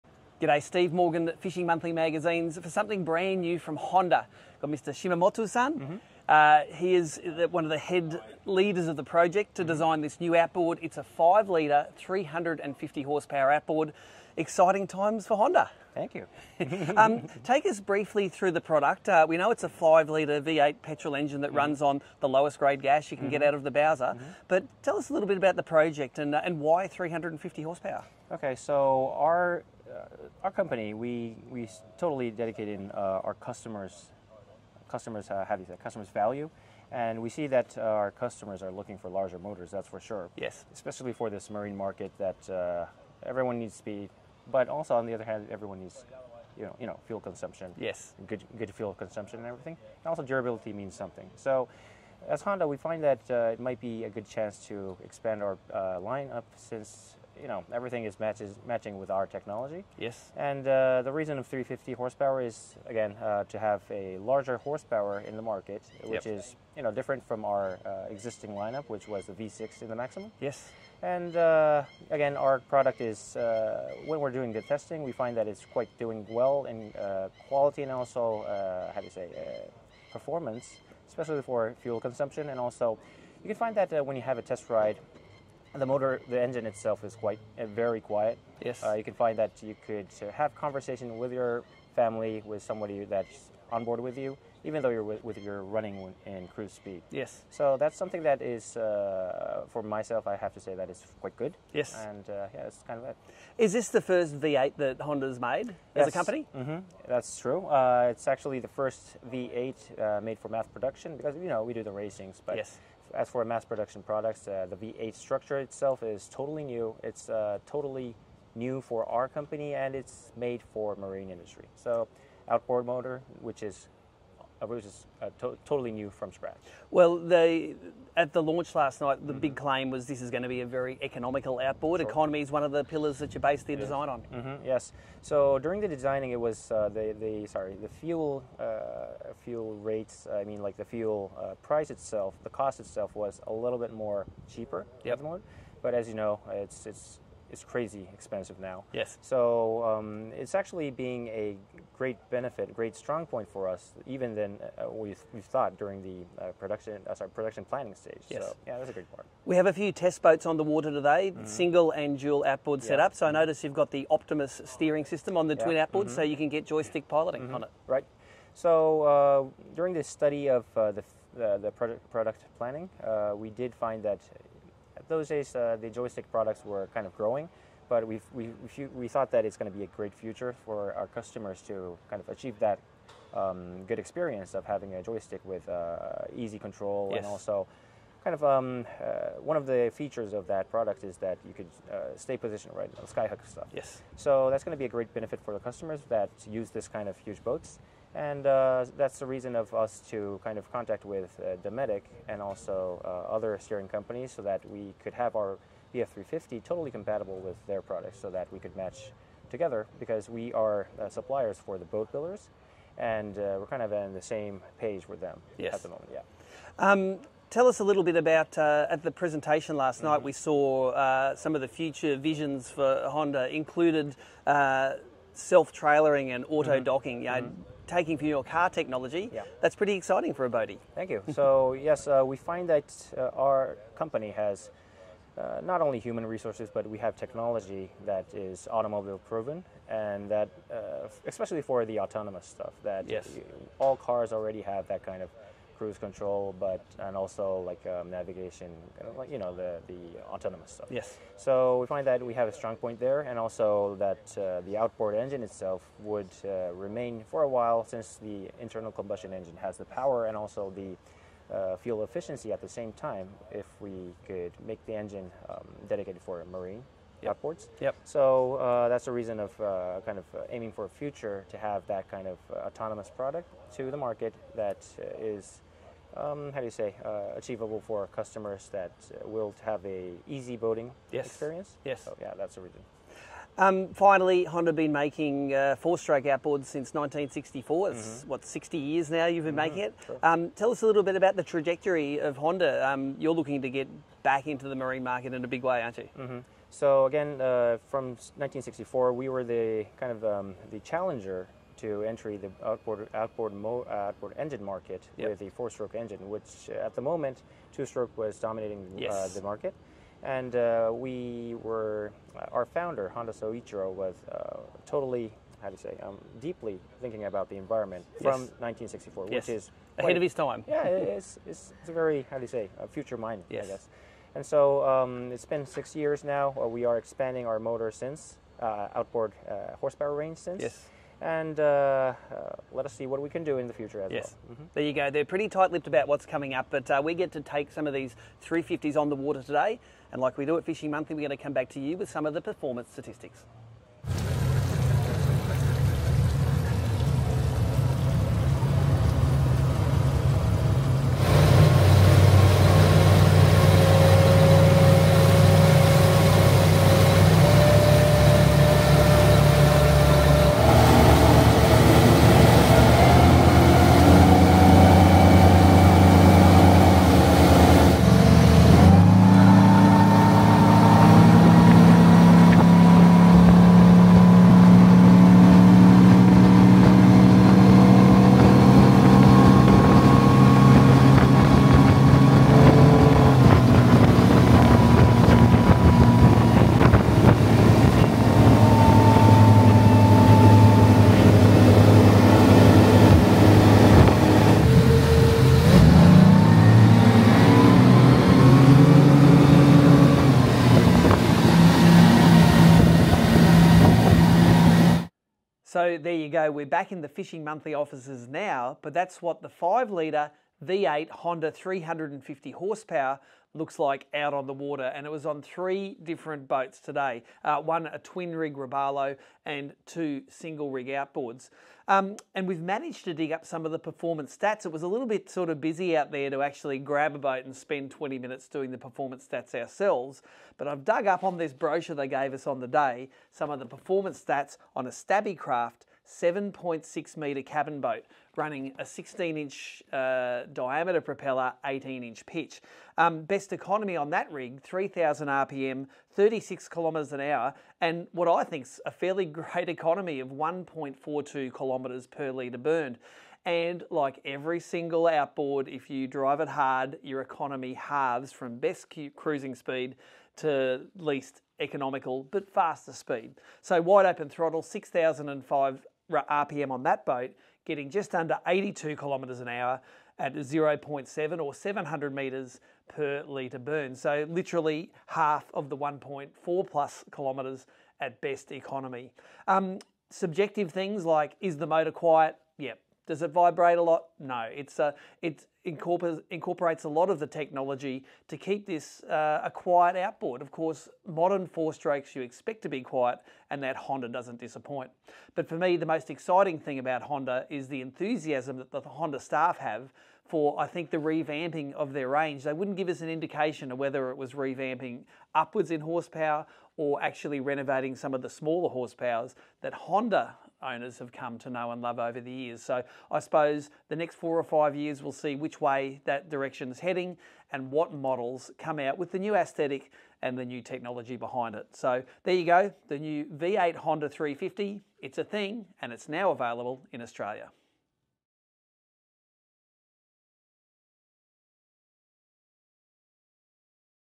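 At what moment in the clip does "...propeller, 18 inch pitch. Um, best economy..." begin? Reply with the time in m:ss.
7:21.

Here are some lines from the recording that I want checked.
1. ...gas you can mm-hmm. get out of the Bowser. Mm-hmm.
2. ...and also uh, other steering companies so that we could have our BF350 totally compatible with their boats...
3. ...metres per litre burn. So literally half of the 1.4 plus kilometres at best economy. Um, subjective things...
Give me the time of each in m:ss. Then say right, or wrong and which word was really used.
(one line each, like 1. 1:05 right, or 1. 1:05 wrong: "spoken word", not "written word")
1. 0:22 right
2. 3:22 wrong: "products", not "boats"
3. 7:52 right.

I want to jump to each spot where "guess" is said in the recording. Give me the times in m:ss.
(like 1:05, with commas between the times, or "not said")
5:23.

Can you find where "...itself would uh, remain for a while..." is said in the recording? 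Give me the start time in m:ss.
4:15.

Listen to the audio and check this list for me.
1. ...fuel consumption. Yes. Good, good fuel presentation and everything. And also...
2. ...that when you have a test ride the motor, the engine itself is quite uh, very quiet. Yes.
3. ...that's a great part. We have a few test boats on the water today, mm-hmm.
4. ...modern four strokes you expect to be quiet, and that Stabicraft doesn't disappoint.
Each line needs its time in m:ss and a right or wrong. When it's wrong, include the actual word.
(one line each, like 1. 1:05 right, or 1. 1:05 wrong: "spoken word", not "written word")
1. 0:47 wrong: "consumption", not "presentation"
2. 1:23 right
3. 2:38 right
4. 8:11 wrong: "Honda", not "Stabicraft".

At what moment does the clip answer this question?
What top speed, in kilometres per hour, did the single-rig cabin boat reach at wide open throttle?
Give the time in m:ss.
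7:47.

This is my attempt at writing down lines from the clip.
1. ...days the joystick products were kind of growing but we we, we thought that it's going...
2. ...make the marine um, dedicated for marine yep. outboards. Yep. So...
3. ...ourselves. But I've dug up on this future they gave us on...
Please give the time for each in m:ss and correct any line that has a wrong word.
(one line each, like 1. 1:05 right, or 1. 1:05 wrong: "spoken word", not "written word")
1. 2:55 right
2. 4:24 wrong: "engine", not "marine"
3. 7:09 wrong: "brochure", not "future".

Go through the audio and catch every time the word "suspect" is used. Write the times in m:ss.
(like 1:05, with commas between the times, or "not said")
not said.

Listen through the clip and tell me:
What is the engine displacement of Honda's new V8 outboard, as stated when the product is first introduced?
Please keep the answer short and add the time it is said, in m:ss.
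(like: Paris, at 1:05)
5 litre, at 0:11.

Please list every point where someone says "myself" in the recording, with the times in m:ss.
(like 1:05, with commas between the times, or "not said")
1:39.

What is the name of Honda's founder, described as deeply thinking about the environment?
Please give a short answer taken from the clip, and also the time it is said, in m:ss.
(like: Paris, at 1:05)
Honda Soichiro, at 5:13.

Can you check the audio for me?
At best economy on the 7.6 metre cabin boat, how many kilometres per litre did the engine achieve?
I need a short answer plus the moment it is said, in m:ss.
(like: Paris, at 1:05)
1.42, at 7:30.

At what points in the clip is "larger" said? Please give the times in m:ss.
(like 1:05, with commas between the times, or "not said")
0:39, 1:04.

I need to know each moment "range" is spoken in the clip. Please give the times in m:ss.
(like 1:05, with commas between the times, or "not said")
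5:30, 8:22.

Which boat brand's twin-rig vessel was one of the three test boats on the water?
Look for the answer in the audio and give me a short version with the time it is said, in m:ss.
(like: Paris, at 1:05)
Robalo, at 6:58.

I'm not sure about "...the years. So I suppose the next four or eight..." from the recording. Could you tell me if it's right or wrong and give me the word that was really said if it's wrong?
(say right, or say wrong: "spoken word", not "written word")
wrong: "five", not "eight".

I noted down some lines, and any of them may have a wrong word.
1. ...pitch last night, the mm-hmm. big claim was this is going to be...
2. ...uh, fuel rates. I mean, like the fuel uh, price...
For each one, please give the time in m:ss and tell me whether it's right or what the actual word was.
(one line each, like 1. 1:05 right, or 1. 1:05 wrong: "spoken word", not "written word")
1. 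2:08 wrong: "launch", not "pitch"
2. 2:18 right.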